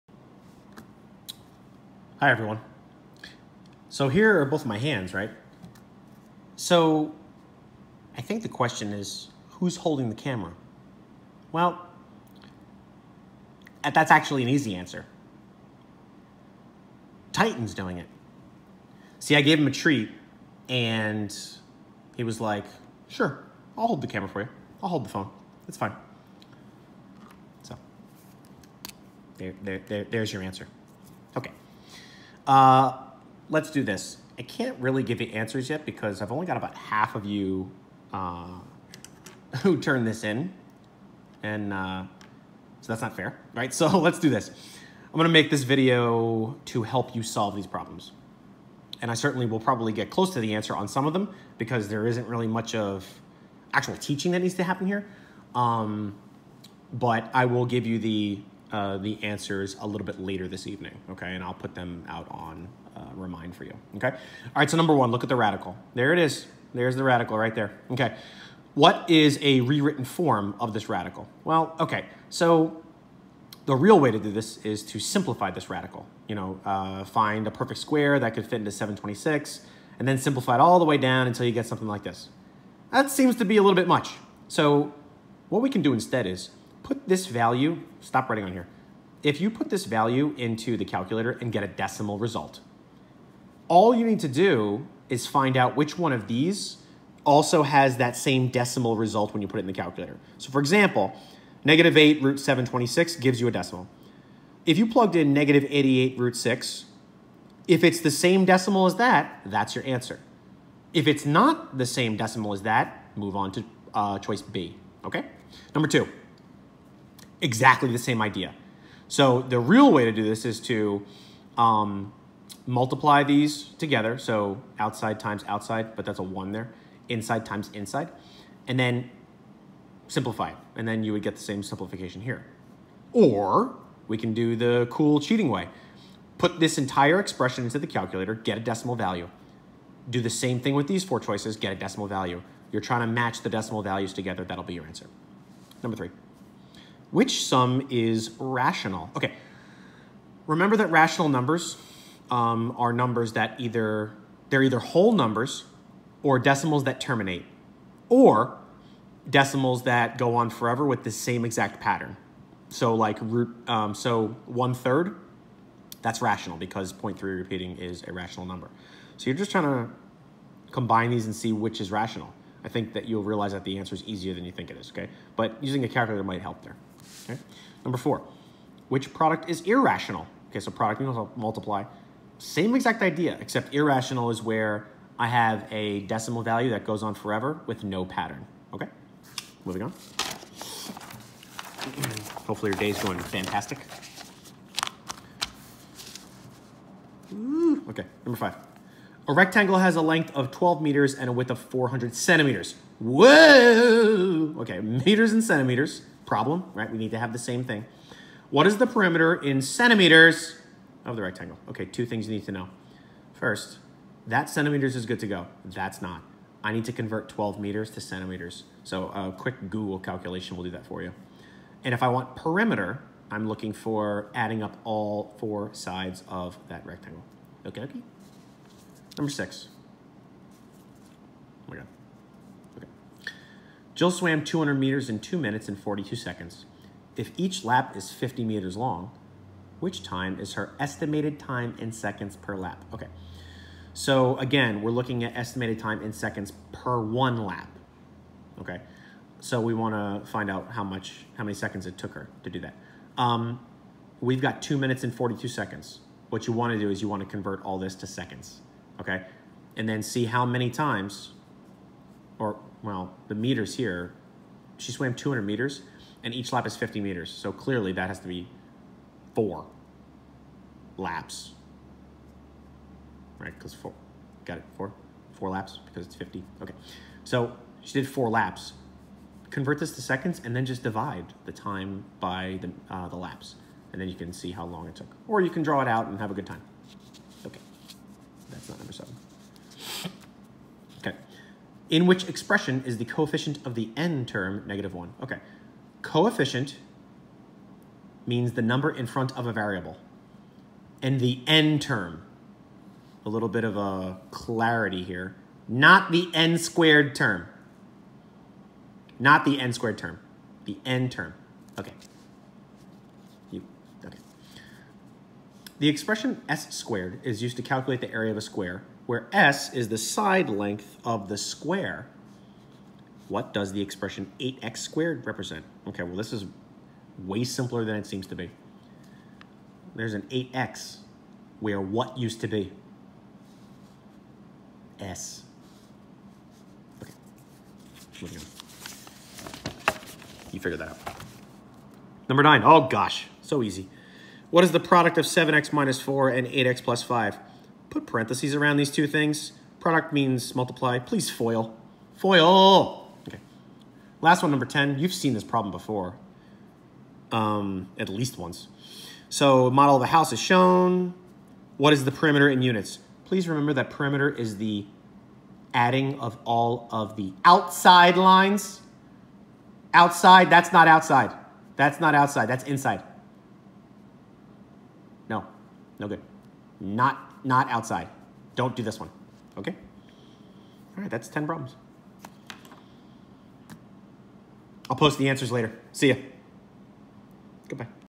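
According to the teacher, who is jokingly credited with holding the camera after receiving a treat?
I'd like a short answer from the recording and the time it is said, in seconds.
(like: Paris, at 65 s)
Titan, at 17 s.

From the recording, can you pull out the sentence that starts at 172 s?
I think that you'll realize that the answer is easier than you think it is, okay?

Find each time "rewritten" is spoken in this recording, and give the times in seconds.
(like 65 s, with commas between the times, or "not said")
69 s.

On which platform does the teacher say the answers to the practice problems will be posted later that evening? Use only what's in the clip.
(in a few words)
Remind.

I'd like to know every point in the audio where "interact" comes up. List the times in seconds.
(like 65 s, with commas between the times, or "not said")
not said.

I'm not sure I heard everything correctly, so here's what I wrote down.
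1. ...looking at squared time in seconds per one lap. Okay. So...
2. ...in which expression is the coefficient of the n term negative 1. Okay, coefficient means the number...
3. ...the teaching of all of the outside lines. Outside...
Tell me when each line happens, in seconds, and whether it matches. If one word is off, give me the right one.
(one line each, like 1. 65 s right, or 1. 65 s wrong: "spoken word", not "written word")
1. 244 s wrong: "estimated", not "squared"
2. 291 s right
3. 364 s wrong: "adding", not "teaching".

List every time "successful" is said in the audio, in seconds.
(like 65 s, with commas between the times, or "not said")
not said.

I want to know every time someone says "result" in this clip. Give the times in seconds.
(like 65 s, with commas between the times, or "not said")
92 s, 98 s.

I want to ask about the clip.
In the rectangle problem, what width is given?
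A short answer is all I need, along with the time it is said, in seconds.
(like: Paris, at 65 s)
400 centimeters, at 201 s.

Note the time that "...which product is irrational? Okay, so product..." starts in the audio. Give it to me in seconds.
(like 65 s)
178 s.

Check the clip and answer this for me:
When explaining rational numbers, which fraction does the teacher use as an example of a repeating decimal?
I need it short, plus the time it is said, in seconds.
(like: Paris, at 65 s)
One third, at 164 s.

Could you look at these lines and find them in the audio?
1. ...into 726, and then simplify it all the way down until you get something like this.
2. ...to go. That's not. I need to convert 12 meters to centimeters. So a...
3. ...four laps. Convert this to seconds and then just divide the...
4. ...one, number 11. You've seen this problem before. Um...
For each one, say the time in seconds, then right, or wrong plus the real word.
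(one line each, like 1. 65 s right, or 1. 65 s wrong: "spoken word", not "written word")
1. 78 s right
2. 215 s right
3. 278 s right
4. 354 s wrong: "10", not "11".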